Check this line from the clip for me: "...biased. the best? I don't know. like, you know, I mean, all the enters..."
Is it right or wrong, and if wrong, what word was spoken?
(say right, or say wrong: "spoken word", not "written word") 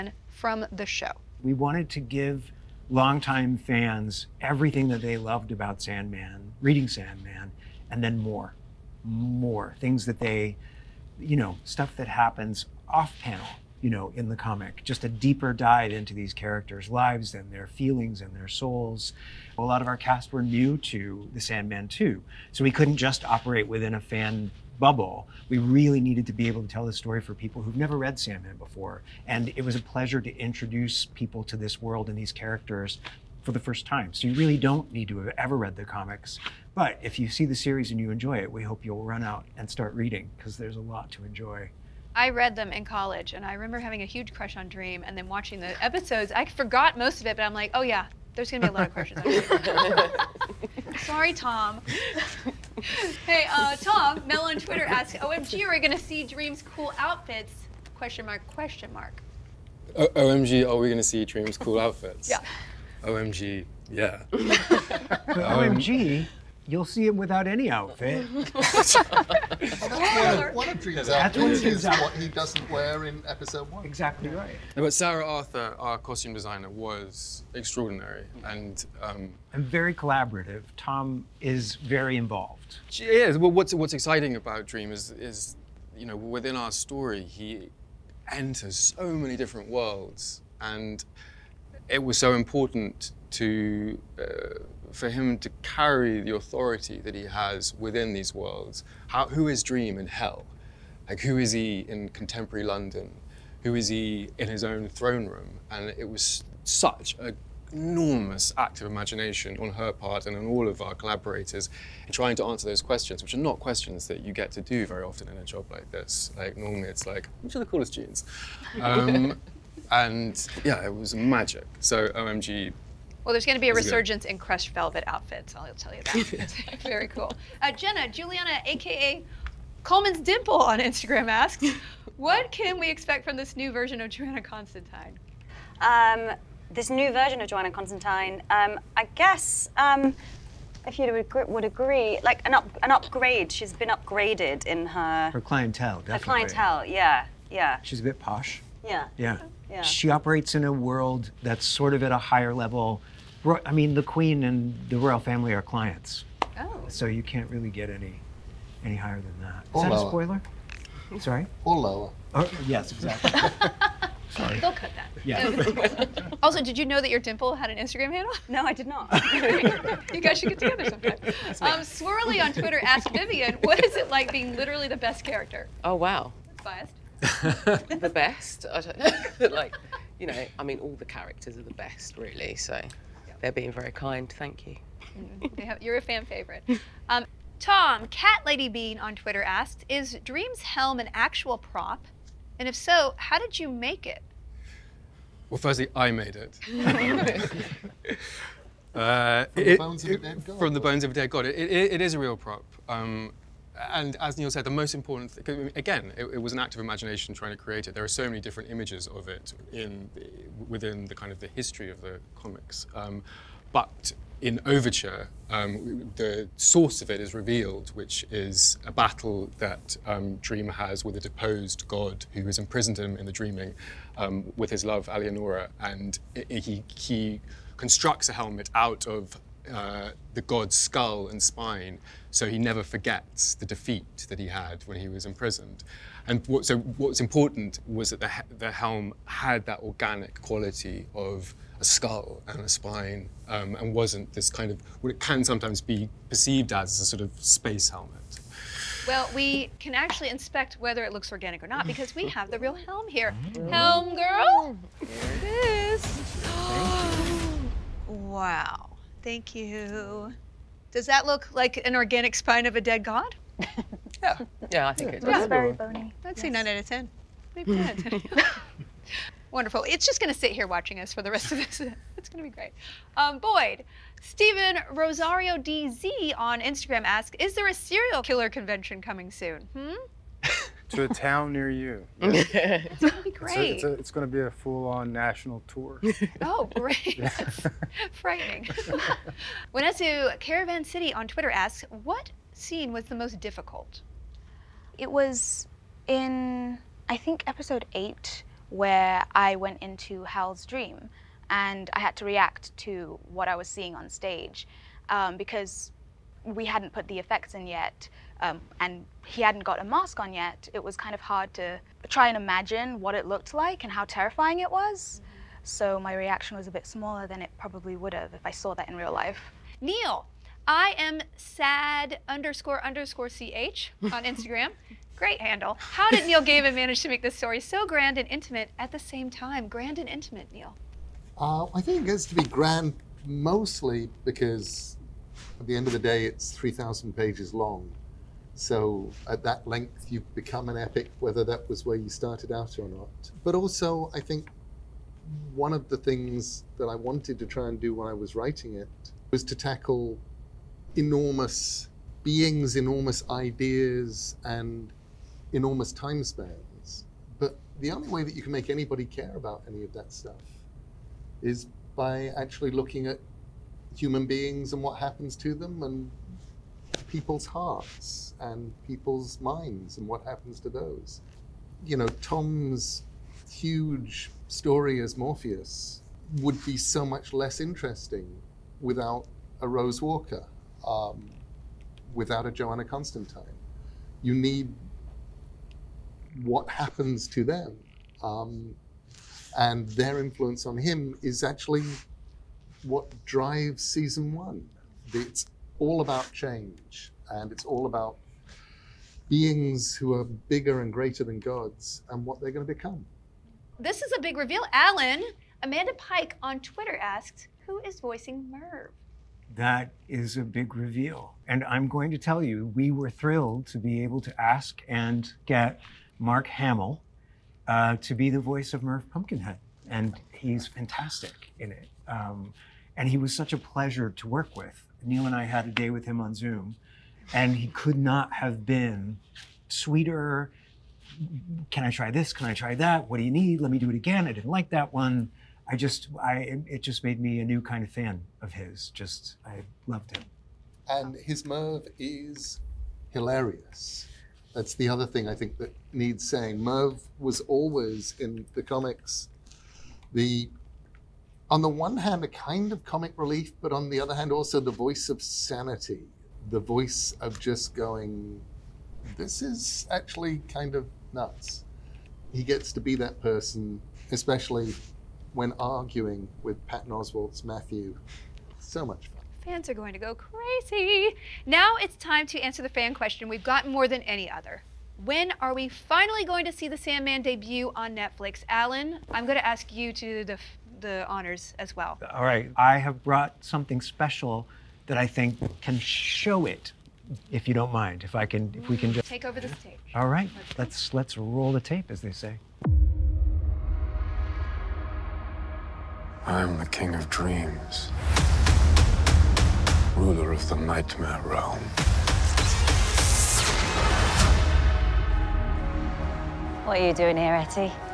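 wrong: "characters", not "enters".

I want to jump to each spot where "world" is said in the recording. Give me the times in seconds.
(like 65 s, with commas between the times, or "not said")
31 s, 89 s, 98 s, 150 s.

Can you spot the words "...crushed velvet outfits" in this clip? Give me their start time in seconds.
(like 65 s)
124 s.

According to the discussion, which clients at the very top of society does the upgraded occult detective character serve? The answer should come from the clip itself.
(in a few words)
The Queen and the royal family.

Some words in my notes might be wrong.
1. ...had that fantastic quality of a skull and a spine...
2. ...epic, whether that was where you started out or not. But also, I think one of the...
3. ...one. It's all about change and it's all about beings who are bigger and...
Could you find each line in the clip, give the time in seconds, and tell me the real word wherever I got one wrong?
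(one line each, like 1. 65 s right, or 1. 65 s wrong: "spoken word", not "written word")
1. 239 s wrong: "organic", not "fantastic"
2. 340 s right
3. 394 s right.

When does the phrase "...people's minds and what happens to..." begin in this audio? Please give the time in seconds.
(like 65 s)
368 s.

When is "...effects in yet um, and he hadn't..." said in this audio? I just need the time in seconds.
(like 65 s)
307 s.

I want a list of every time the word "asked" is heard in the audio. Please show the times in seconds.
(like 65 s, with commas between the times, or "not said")
172 s, 189 s, 406 s.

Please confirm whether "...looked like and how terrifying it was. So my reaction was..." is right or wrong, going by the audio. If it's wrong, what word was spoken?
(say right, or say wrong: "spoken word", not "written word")
right.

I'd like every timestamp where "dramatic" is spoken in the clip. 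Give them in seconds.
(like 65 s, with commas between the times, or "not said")
not said.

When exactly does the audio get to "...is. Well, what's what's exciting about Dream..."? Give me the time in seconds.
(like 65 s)
83 s.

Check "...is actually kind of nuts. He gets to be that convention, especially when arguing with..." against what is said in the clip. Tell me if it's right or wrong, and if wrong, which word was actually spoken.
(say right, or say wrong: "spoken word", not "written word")
wrong: "person", not "convention".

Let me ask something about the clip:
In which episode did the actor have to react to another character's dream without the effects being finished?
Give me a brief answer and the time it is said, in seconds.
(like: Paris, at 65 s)
Episode 8, at 297 s.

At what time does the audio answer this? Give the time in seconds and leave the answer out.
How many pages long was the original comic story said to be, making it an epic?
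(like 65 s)
336 s.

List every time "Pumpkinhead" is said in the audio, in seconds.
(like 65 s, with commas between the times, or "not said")
419 s.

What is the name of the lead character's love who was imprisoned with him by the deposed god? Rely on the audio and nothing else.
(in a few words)
Alianora.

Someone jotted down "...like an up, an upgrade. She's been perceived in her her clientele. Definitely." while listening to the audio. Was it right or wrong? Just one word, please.
wrong.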